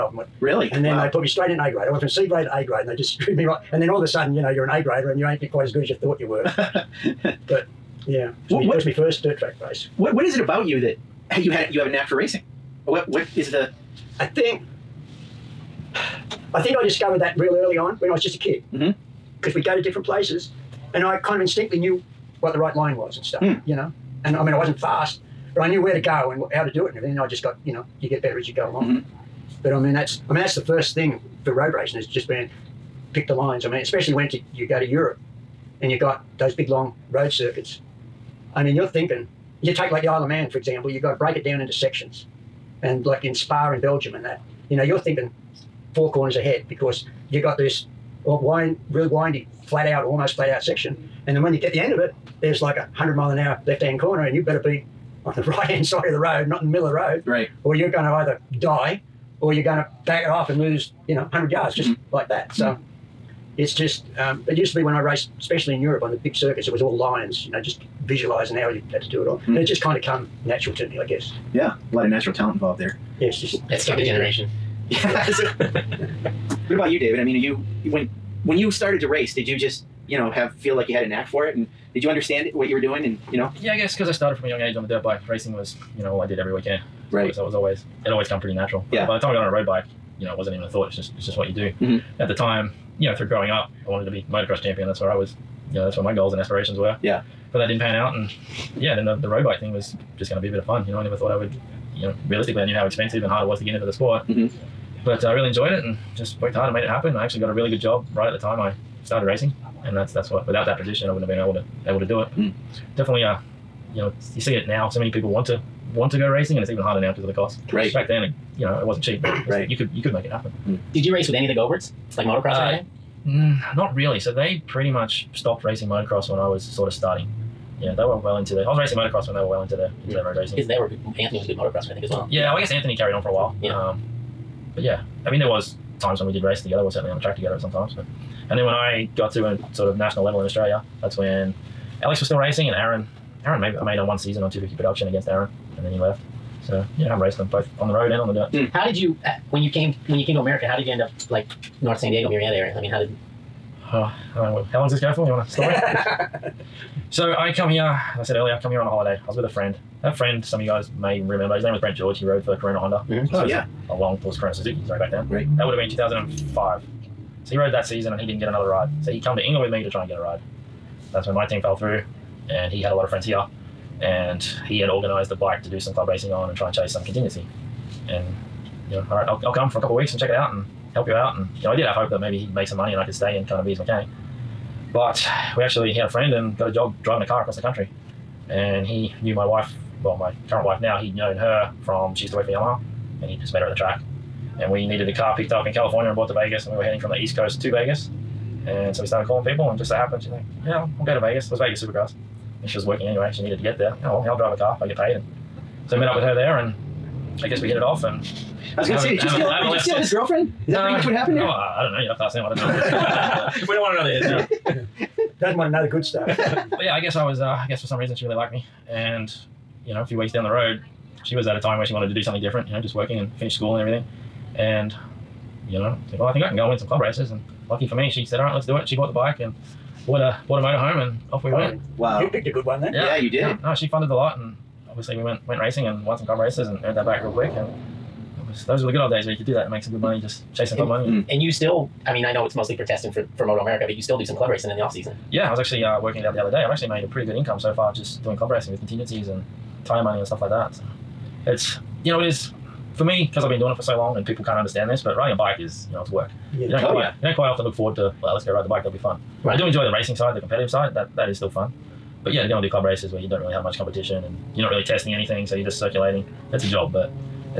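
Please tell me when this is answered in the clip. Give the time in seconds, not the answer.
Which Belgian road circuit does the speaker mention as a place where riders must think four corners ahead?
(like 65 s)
43 s.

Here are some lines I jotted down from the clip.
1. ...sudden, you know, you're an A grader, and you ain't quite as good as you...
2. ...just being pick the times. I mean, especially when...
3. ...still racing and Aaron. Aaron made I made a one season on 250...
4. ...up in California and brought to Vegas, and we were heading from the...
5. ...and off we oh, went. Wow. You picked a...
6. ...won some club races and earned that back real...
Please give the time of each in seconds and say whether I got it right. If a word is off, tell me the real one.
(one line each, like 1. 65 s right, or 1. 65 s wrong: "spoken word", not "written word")
1. 4 s right
2. 32 s wrong: "lines", not "times"
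3. 142 s right
4. 195 s right
5. 231 s right
6. 236 s right.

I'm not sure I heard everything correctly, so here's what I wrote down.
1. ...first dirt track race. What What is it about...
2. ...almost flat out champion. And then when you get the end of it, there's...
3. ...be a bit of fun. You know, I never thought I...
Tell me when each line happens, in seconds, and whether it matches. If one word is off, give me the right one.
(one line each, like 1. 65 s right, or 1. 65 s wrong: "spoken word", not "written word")
1. 8 s right
2. 50 s wrong: "section", not "champion"
3. 100 s right.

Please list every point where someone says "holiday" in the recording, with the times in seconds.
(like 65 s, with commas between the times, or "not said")
158 s.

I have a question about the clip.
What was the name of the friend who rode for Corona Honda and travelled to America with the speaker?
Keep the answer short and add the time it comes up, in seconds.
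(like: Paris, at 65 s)
Brent George, at 161 s.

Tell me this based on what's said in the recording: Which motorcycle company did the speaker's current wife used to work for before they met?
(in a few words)
Yamaha.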